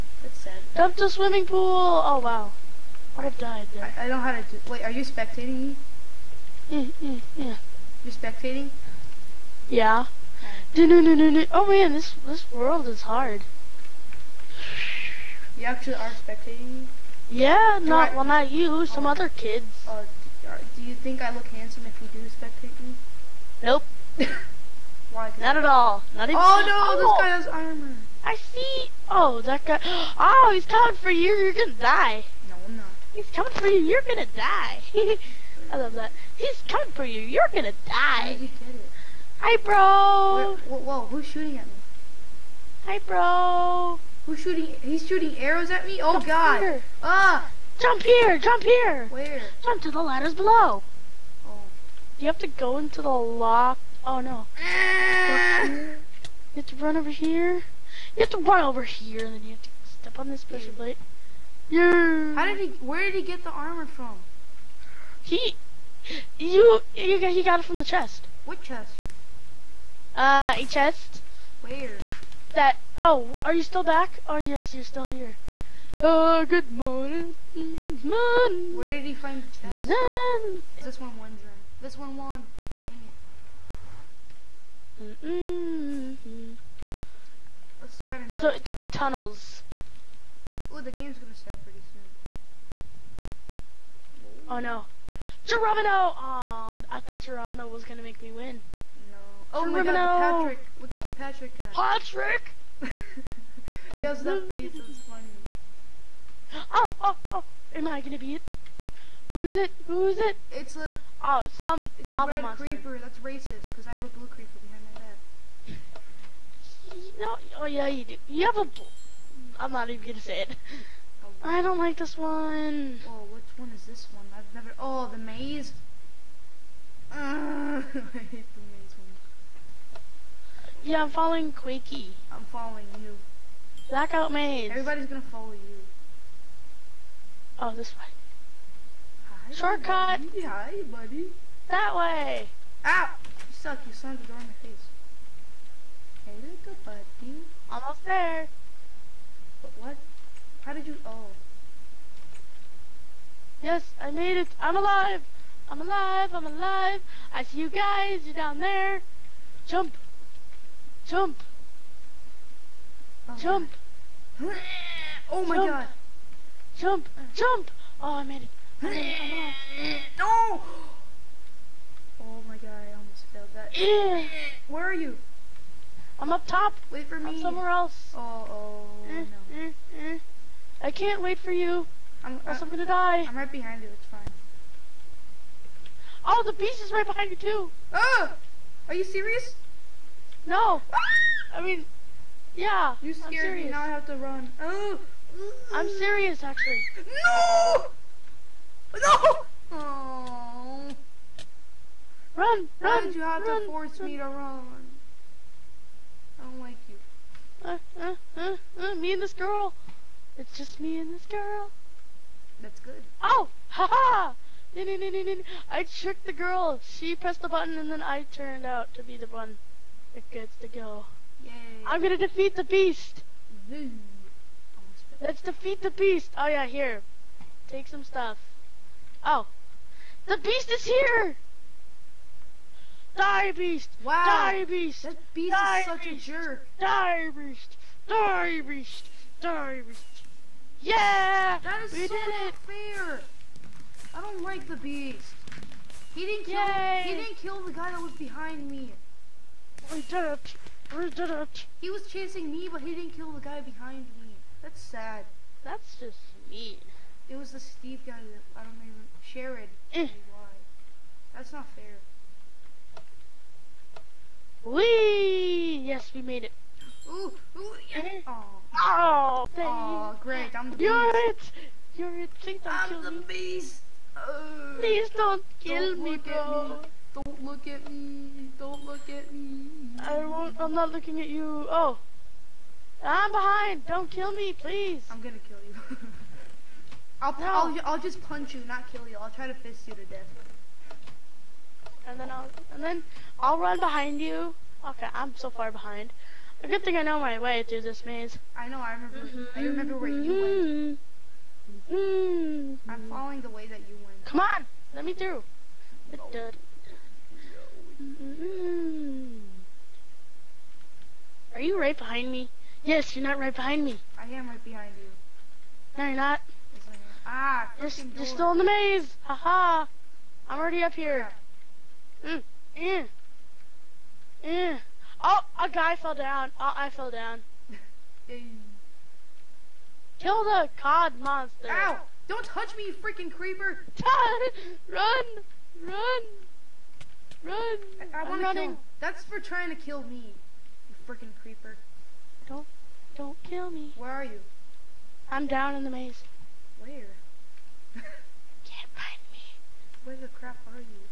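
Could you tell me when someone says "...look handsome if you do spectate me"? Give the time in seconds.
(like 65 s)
21 s.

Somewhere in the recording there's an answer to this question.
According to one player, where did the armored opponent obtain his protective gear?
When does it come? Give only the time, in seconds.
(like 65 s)
67 s.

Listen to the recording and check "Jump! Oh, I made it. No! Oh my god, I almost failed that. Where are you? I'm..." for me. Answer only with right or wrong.
right.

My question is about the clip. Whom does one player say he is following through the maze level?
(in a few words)
Quakey.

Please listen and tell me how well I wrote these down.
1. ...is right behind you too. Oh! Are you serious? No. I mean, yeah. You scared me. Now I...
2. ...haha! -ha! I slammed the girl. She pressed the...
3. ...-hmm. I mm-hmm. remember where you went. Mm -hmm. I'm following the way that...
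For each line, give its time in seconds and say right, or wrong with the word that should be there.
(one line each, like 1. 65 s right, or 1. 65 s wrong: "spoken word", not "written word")
1. 186 s right
2. 213 s wrong: "tricked", not "slammed"
3. 299 s right.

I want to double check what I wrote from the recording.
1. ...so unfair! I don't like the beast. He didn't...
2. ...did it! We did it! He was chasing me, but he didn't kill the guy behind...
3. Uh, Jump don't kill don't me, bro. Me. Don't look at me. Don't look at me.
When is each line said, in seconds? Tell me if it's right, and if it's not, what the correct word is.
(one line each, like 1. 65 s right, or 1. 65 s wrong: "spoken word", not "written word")
1. 242 s right
2. 250 s right
3. 274 s wrong: "Please", not "Jump".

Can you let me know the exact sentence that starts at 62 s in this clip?
How did he, where did he get the armor from?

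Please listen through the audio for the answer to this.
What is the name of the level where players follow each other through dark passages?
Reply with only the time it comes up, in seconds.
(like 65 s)
133 s.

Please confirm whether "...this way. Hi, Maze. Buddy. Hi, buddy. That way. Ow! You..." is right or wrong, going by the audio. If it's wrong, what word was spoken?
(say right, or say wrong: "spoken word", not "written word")
wrong: "Shortcut", not "Maze".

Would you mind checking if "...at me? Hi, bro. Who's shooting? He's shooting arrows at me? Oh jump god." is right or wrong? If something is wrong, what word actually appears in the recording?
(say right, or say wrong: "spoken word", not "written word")
right.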